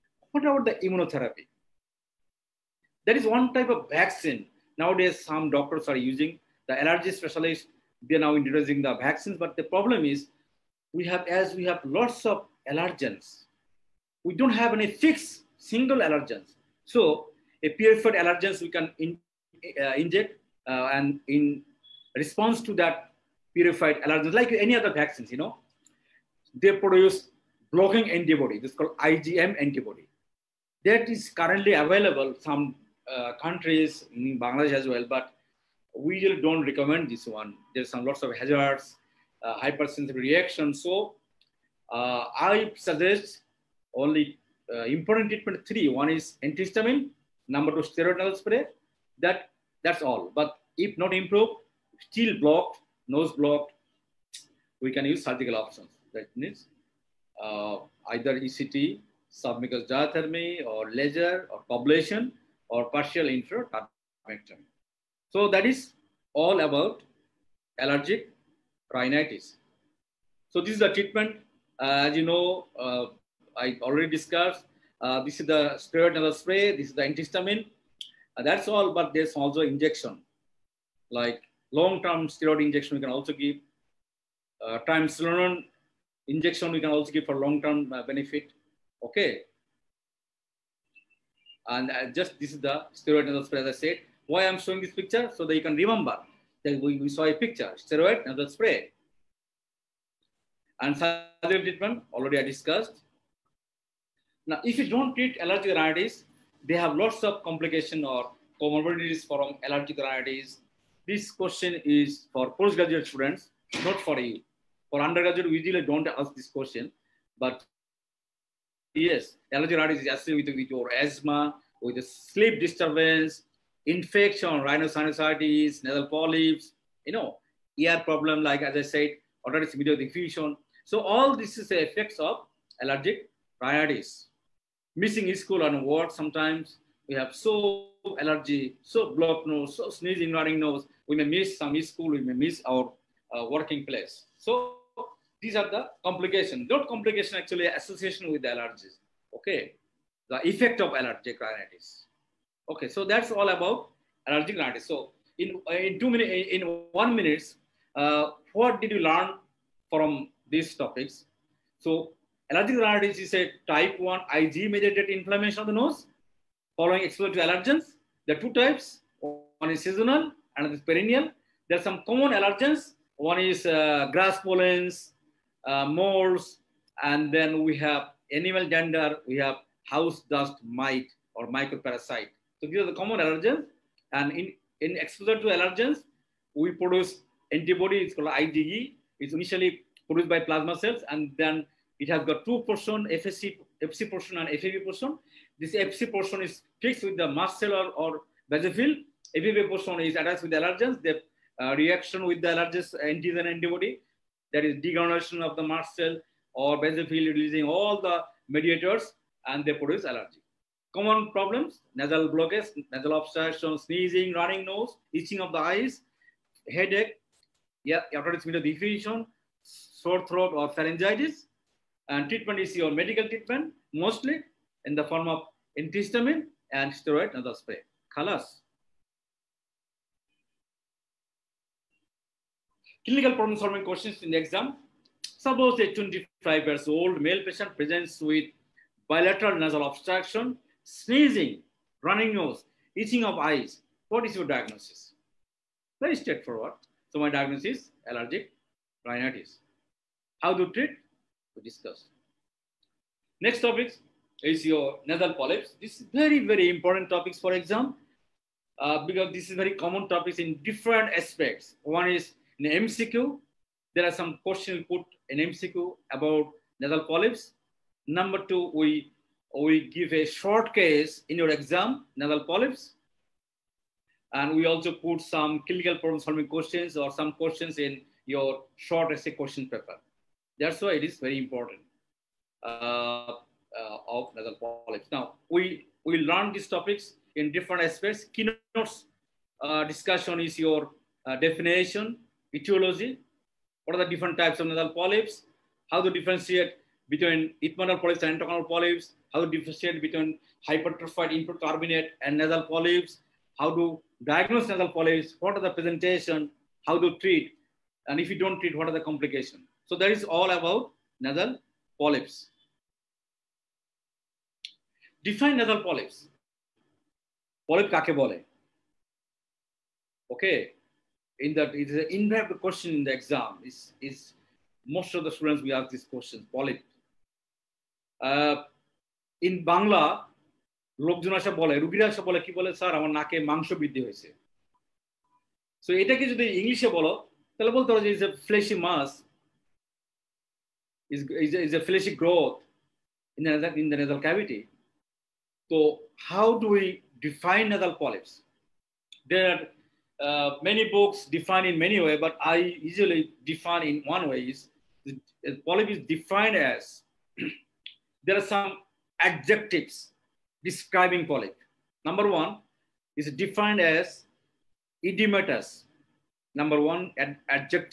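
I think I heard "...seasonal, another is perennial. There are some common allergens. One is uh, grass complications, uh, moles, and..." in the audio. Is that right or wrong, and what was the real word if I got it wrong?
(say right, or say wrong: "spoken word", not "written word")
wrong: "pollens", not "complications".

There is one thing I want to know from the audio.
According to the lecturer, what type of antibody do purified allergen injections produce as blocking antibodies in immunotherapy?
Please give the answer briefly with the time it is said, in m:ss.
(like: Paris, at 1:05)
IgM, at 0:28.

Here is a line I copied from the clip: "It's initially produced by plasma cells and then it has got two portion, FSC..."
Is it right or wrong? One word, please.
right.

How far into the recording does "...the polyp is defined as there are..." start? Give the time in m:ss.
5:55.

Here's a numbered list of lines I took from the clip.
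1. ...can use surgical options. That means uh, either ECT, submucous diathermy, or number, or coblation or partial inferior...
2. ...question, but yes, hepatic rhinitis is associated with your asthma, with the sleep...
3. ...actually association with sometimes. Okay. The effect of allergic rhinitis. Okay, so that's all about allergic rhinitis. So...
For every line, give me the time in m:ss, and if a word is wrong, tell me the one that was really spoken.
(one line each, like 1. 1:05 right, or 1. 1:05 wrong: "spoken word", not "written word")
1. 0:54 wrong: "laser", not "number"
2. 1:56 wrong: "allergic", not "hepatic"
3. 2:27 wrong: "allergies", not "sometimes".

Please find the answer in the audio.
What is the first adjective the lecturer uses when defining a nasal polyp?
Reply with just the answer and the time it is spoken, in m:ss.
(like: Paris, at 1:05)
Edematous, at 6:05.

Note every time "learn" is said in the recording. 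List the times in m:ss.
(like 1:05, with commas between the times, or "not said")
2:38, 4:46.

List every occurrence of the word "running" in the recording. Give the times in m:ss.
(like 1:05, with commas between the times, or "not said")
2:20, 3:34, 4:02.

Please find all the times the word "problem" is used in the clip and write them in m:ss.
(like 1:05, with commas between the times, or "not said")
0:09, 2:07, 3:31, 3:53, 4:35.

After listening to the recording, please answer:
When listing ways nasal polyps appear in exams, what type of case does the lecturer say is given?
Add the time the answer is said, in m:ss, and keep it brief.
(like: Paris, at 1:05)
Short case, at 4:30.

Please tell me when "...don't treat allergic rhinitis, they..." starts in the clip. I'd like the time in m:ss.
1:44.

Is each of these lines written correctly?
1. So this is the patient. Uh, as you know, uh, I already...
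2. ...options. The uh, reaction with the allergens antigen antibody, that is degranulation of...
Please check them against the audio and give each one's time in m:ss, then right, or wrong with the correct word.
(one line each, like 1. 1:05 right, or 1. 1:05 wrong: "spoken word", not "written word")
1. 1:10 wrong: "treatment", not "patient"
2. 3:20 wrong: "allergens", not "options".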